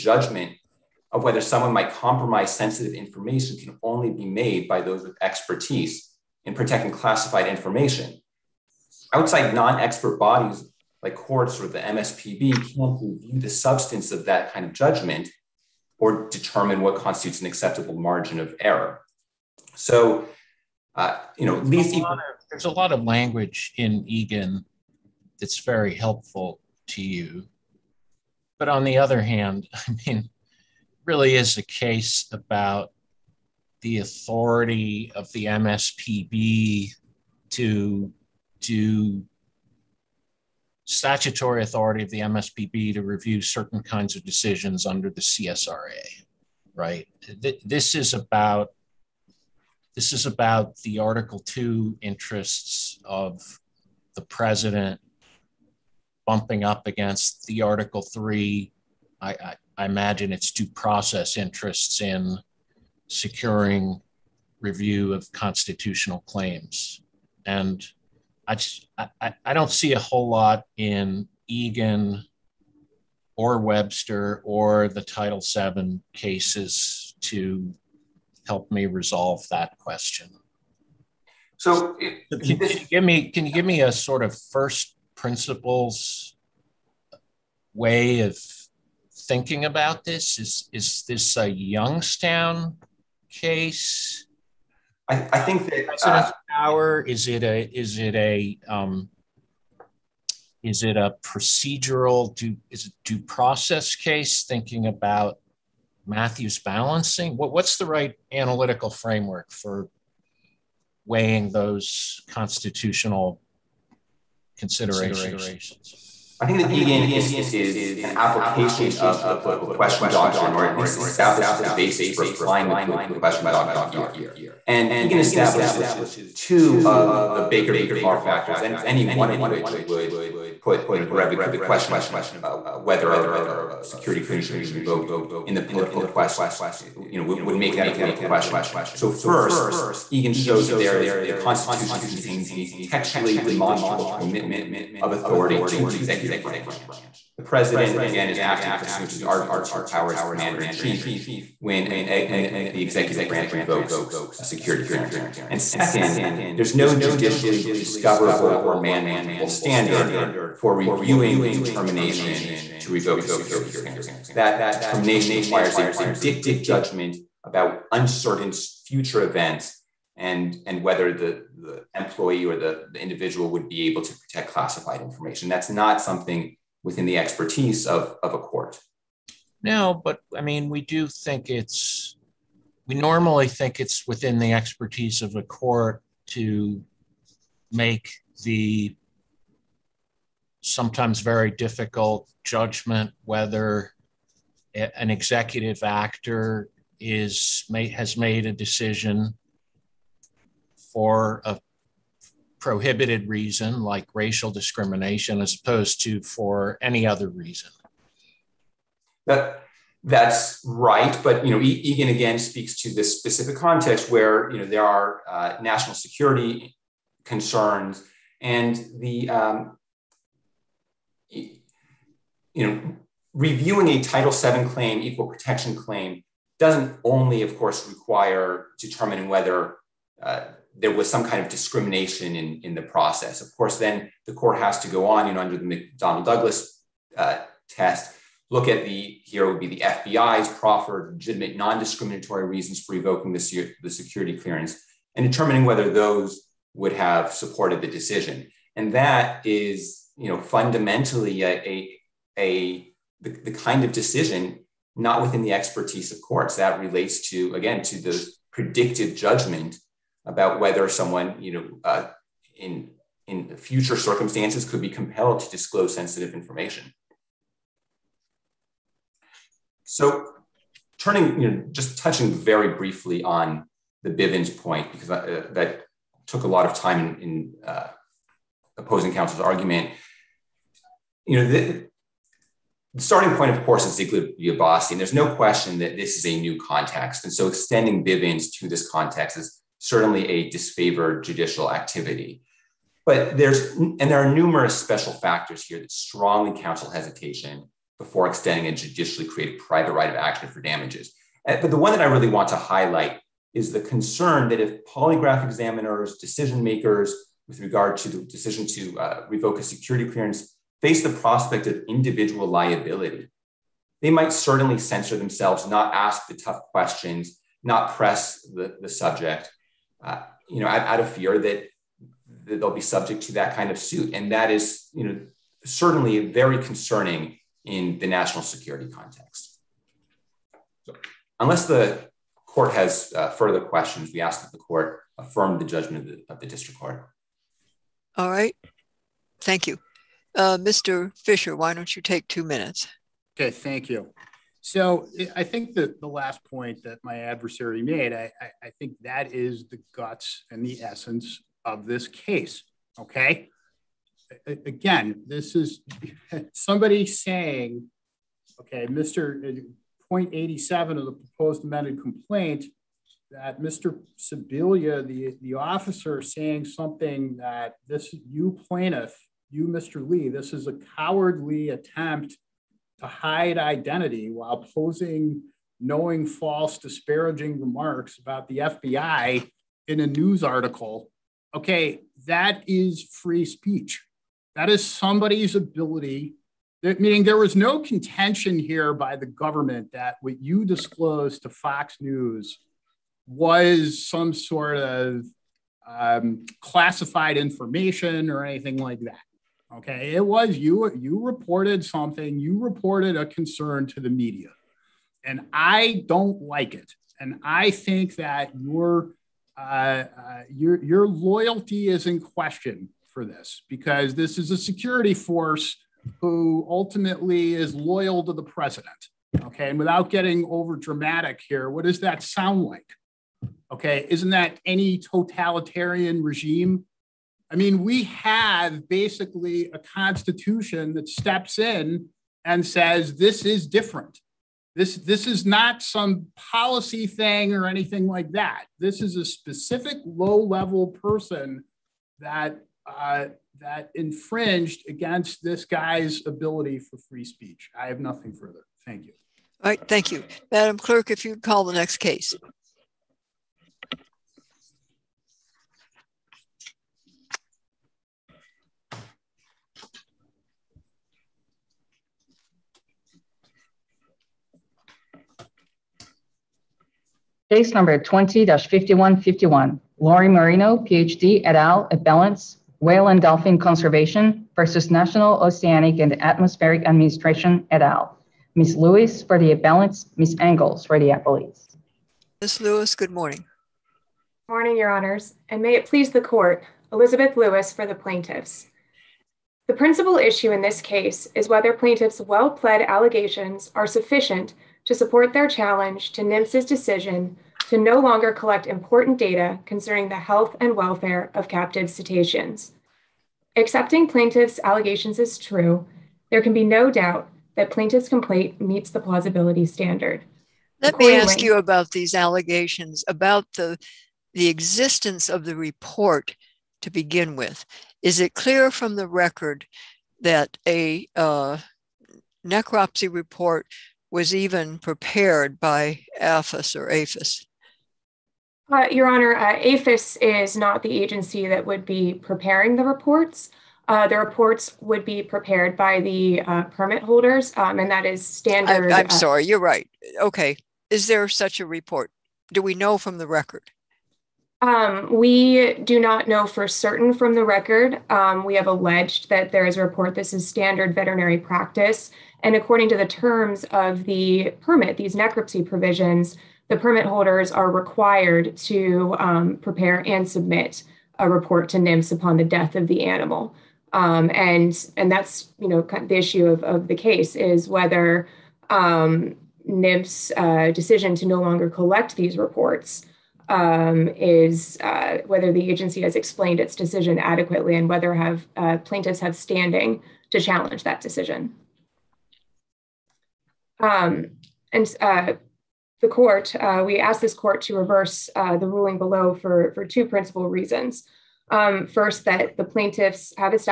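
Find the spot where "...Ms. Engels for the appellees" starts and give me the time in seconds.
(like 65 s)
480 s.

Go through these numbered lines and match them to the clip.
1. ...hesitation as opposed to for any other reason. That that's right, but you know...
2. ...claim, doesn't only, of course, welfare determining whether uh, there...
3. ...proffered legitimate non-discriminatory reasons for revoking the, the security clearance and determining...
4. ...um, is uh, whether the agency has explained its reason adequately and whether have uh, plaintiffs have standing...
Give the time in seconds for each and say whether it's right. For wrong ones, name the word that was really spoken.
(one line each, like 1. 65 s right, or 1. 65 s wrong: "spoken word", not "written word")
1. 204 s wrong: "discrimination", not "hesitation"
2. 225 s wrong: "require", not "welfare"
3. 240 s right
4. 573 s wrong: "decision", not "reason".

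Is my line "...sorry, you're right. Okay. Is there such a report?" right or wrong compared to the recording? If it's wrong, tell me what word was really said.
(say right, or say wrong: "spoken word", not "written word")
right.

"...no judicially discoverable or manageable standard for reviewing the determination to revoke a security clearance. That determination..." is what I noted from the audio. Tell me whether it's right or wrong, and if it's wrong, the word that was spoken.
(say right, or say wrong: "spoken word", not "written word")
right.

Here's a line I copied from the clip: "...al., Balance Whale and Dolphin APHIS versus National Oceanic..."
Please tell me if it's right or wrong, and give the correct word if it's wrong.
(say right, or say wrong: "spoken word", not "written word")
wrong: "Conservation", not "APHIS".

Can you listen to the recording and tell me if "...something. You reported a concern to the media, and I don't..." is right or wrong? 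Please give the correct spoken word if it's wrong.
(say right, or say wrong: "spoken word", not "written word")
right.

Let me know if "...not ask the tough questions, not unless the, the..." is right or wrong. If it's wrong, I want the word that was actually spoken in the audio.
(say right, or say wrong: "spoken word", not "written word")
wrong: "press", not "unless".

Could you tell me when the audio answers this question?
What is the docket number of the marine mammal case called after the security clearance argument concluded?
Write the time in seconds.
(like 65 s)
467 s.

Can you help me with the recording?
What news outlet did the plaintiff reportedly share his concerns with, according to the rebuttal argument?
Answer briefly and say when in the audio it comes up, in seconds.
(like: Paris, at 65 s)
Fox News, at 391 s.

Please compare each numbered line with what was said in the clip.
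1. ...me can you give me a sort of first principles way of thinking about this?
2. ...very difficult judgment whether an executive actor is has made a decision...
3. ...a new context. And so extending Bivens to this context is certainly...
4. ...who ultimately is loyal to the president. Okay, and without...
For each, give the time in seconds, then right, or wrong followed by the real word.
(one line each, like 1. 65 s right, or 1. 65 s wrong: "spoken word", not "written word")
1. 83 s right
2. 191 s right
3. 286 s right
4. 416 s right.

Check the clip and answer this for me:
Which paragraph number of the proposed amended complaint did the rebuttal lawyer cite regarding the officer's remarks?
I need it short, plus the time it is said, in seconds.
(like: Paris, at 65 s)
87, at 360 s.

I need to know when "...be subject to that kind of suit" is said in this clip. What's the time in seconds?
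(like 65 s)
322 s.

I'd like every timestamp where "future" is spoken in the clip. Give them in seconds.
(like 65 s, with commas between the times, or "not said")
168 s, 263 s.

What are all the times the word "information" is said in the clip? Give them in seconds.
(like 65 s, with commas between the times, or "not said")
2 s, 7 s, 175 s, 266 s, 397 s.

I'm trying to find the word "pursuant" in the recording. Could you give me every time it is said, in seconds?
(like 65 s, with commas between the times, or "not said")
148 s.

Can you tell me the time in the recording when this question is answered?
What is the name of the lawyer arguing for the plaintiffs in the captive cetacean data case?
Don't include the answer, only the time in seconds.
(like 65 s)
486 s.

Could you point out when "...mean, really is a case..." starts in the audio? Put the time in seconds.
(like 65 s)
30 s.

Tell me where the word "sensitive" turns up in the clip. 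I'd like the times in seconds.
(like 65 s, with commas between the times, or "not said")
2 s, 265 s.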